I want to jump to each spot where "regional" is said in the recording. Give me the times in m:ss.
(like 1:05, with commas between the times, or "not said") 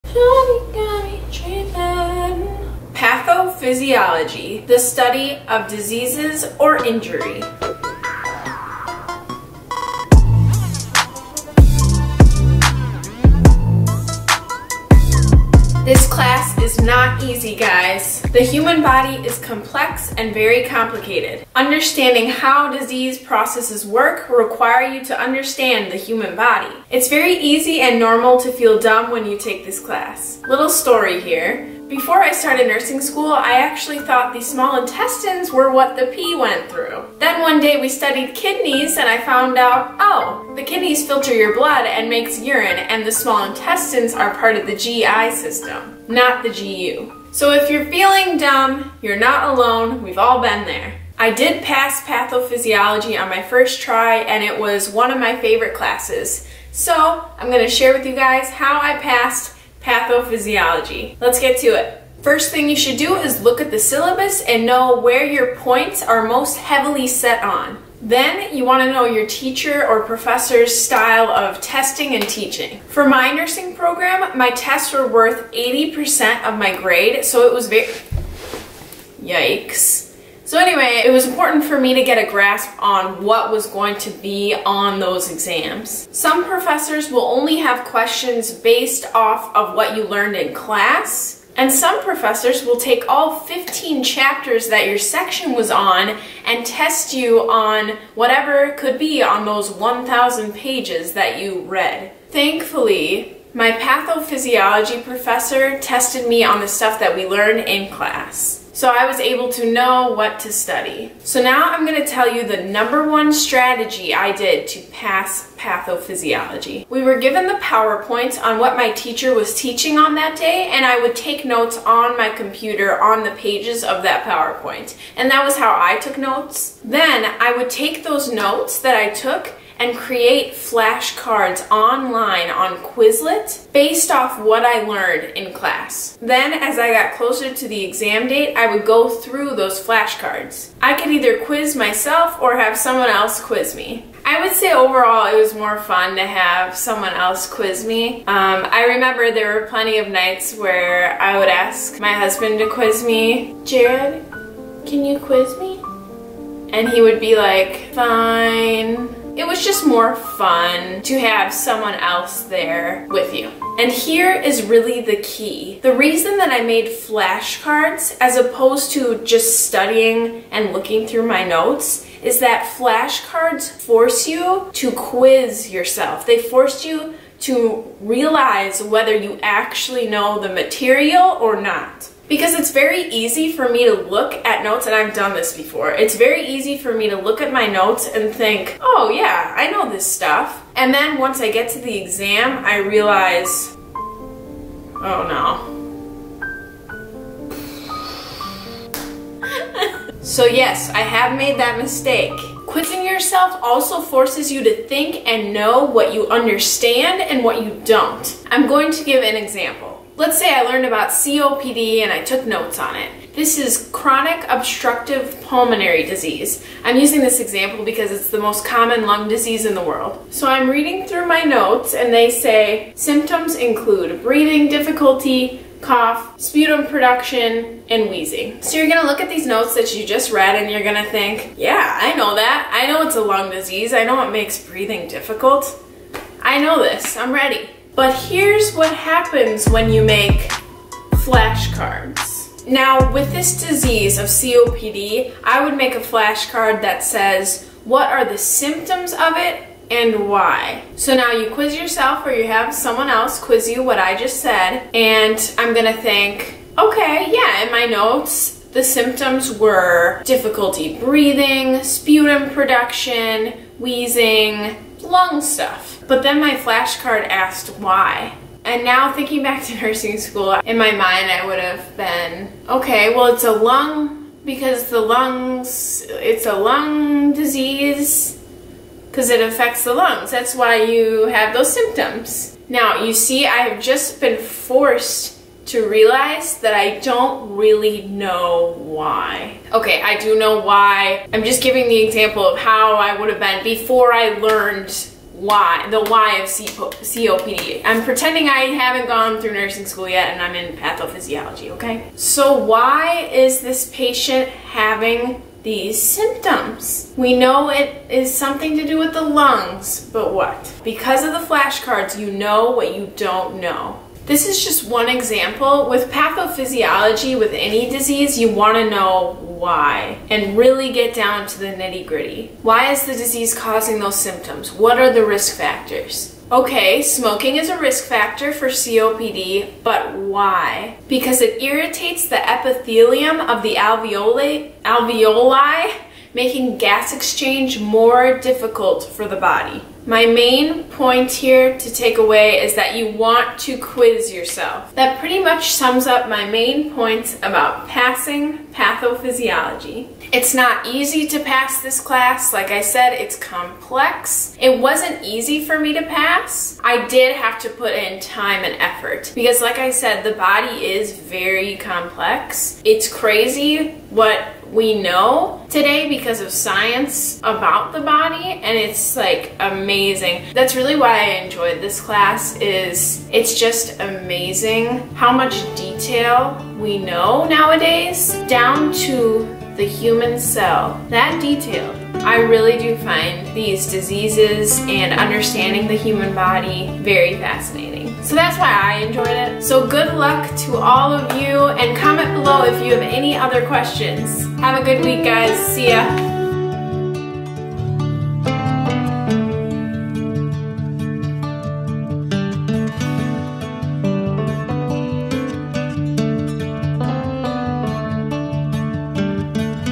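not said.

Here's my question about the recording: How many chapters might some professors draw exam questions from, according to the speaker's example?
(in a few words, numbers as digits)
15.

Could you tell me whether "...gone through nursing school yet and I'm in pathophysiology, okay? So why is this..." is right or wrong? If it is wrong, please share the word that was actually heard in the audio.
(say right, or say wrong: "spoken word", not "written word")
right.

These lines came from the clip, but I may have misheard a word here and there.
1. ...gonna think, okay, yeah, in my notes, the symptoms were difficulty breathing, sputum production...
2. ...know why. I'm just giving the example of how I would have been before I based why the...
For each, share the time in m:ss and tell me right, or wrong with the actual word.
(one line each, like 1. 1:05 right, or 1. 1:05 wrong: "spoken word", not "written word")
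1. 4:15 right
2. 4:50 wrong: "learned", not "based".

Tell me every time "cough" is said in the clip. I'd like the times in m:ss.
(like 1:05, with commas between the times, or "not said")
3:45.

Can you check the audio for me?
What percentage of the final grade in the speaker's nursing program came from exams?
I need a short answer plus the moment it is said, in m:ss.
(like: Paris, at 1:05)
80%, at 1:15.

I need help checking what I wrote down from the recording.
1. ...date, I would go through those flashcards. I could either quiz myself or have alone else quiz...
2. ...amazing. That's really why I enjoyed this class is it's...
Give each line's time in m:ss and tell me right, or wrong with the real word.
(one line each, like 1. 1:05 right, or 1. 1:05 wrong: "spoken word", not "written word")
1. 2:18 wrong: "someone", not "alone"
2. 6:09 right.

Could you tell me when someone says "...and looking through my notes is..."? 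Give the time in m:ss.
2:50.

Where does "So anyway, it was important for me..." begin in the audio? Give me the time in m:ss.
1:20.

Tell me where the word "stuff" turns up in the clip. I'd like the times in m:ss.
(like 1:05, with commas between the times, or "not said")
1:46, 3:10, 4:25.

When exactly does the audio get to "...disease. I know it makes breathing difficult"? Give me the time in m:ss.
3:53.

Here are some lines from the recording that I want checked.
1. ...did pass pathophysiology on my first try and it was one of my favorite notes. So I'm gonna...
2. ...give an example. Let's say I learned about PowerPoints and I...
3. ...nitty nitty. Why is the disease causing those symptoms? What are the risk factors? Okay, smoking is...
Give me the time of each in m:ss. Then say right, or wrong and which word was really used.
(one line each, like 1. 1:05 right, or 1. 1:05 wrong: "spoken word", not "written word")
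1. 0:51 wrong: "classes", not "notes"
2. 3:29 wrong: "COPD", not "PowerPoints"
3. 5:21 wrong: "gritty", not "nitty".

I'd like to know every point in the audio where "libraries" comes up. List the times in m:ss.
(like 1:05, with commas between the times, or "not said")
not said.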